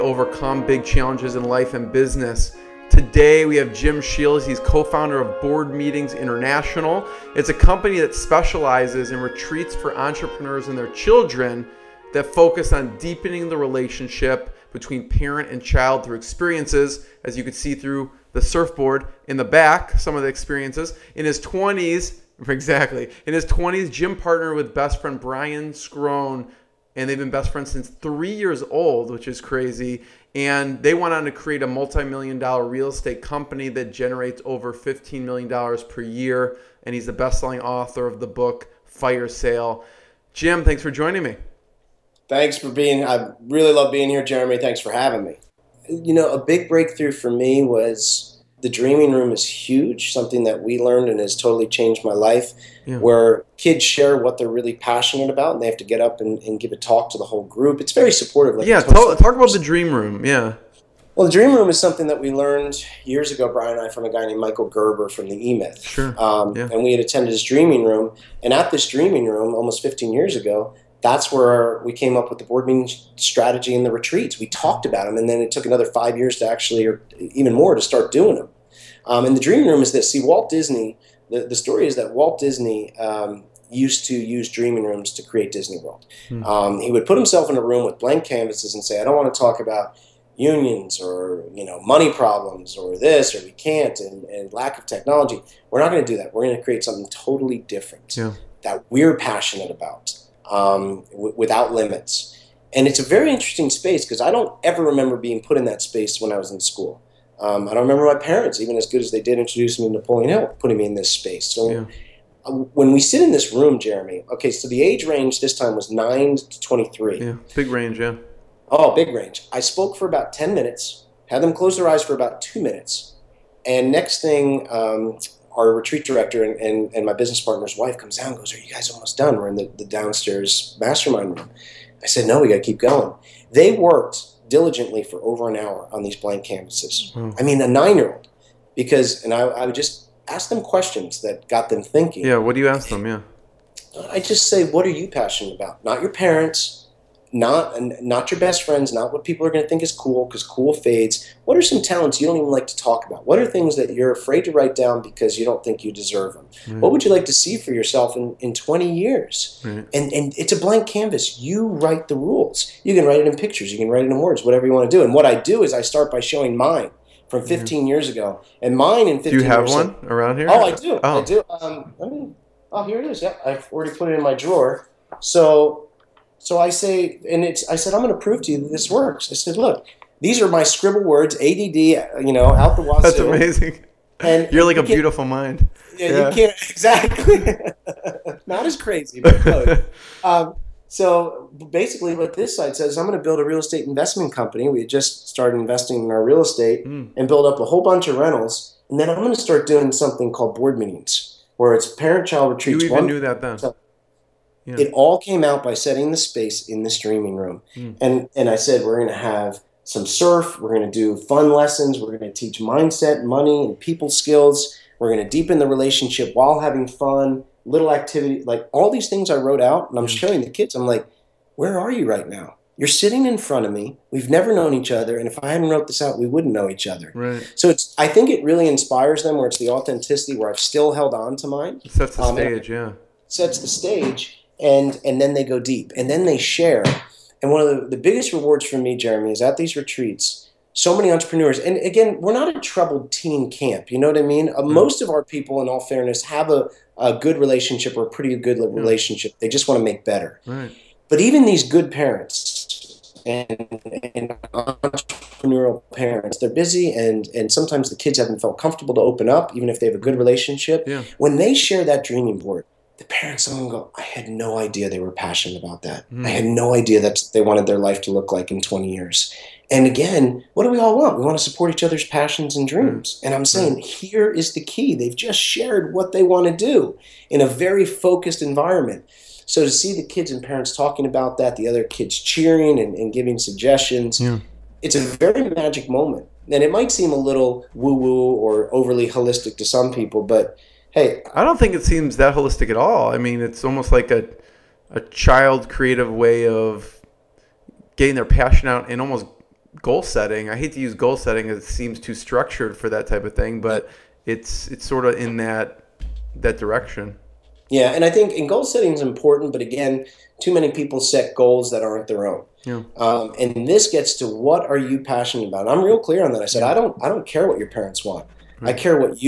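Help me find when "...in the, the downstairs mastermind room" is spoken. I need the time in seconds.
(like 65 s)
129 s.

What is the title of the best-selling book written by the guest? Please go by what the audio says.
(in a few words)
Fire Sale.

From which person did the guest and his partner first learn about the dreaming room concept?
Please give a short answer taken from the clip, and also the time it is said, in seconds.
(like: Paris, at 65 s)
Michael Gerber, at 64 s.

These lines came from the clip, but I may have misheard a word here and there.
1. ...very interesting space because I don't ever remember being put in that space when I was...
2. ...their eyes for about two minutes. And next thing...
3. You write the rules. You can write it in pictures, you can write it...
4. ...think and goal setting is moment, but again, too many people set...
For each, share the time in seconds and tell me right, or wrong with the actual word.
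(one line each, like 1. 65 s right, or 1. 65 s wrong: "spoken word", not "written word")
1. 103 s right
2. 121 s right
3. 161 s right
4. 308 s wrong: "important", not "moment".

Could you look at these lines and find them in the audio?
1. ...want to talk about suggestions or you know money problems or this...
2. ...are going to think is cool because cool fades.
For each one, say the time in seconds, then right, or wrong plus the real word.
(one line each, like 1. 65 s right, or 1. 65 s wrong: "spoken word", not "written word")
1. 89 s wrong: "unions", not "suggestions"
2. 149 s right.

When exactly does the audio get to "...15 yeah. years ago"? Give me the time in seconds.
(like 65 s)
167 s.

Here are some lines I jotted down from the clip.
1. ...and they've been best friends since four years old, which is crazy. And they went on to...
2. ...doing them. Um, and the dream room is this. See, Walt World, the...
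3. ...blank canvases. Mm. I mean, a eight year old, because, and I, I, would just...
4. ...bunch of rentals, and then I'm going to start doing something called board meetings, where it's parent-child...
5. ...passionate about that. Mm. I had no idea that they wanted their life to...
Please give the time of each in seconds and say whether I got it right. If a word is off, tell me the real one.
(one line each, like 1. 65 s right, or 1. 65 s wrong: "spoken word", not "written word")
1. 26 s wrong: "three", not "four"
2. 78 s wrong: "Disney", not "World"
3. 136 s wrong: "nine", not "eight"
4. 197 s right
5. 265 s right.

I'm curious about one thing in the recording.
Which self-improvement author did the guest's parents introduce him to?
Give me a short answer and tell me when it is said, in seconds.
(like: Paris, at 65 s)
Napoleon Hill, at 109 s.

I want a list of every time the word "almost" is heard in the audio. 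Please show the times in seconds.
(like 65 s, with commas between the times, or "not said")
69 s, 128 s, 293 s, 299 s.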